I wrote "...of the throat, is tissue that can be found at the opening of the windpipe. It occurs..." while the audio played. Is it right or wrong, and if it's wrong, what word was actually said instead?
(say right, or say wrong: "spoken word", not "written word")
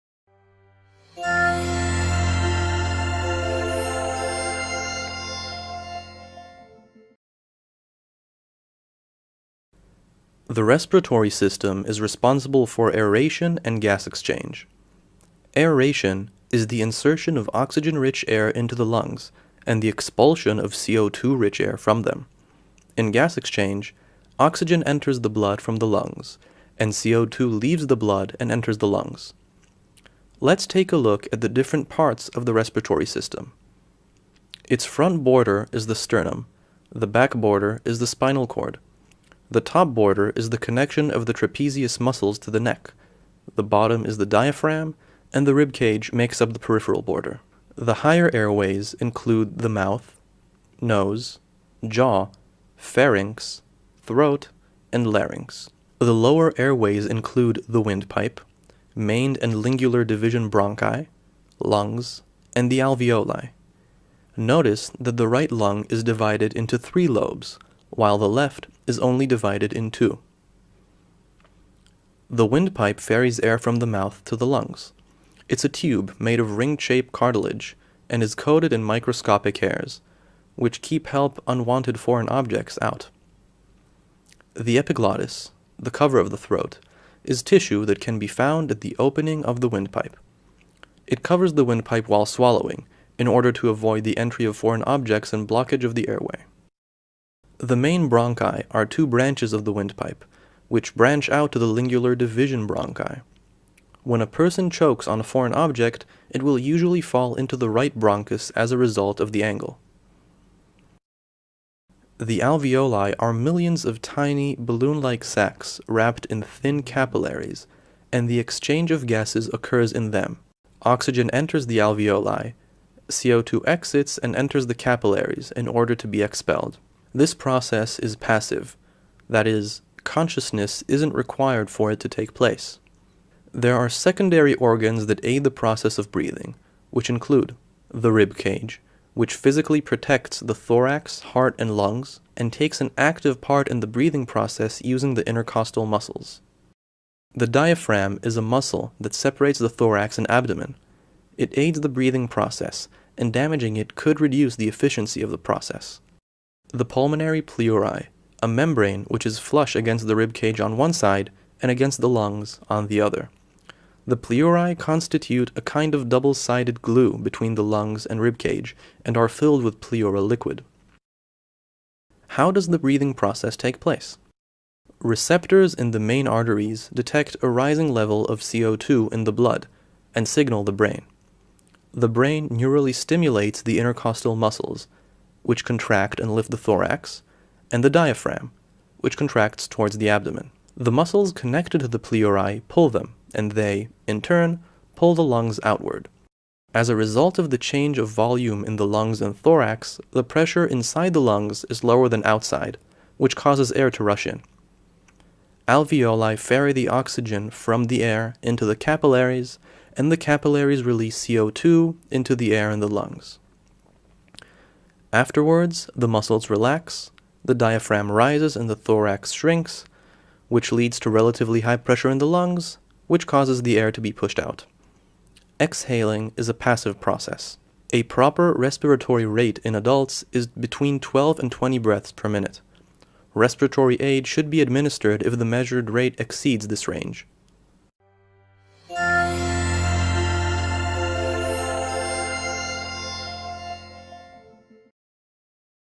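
wrong: "covers", not "occurs".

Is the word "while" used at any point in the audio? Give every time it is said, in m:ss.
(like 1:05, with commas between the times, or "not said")
1:07, 1:32.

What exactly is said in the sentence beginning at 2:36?
The pulmonary pleurae, a membrane which is flush against the rib cage on one side and against the lungs on the other.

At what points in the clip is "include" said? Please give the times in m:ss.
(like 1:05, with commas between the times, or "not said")
0:48, 0:57, 2:17.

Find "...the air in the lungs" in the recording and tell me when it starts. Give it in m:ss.
3:32.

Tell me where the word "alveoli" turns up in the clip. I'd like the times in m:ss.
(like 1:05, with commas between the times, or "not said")
1:02, 1:52, 2:01, 3:25.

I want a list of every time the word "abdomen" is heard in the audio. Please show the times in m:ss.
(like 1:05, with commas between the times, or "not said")
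2:30, 3:10.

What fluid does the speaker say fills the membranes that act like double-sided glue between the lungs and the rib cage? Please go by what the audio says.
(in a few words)
pleural liquid.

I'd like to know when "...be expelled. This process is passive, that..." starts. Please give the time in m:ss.
2:06.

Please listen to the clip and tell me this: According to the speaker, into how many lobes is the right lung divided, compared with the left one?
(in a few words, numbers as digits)
3.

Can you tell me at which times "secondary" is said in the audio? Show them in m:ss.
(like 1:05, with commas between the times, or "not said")
2:13.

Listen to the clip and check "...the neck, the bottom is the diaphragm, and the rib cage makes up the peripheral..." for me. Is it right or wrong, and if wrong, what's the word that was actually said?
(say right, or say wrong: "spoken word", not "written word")
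right.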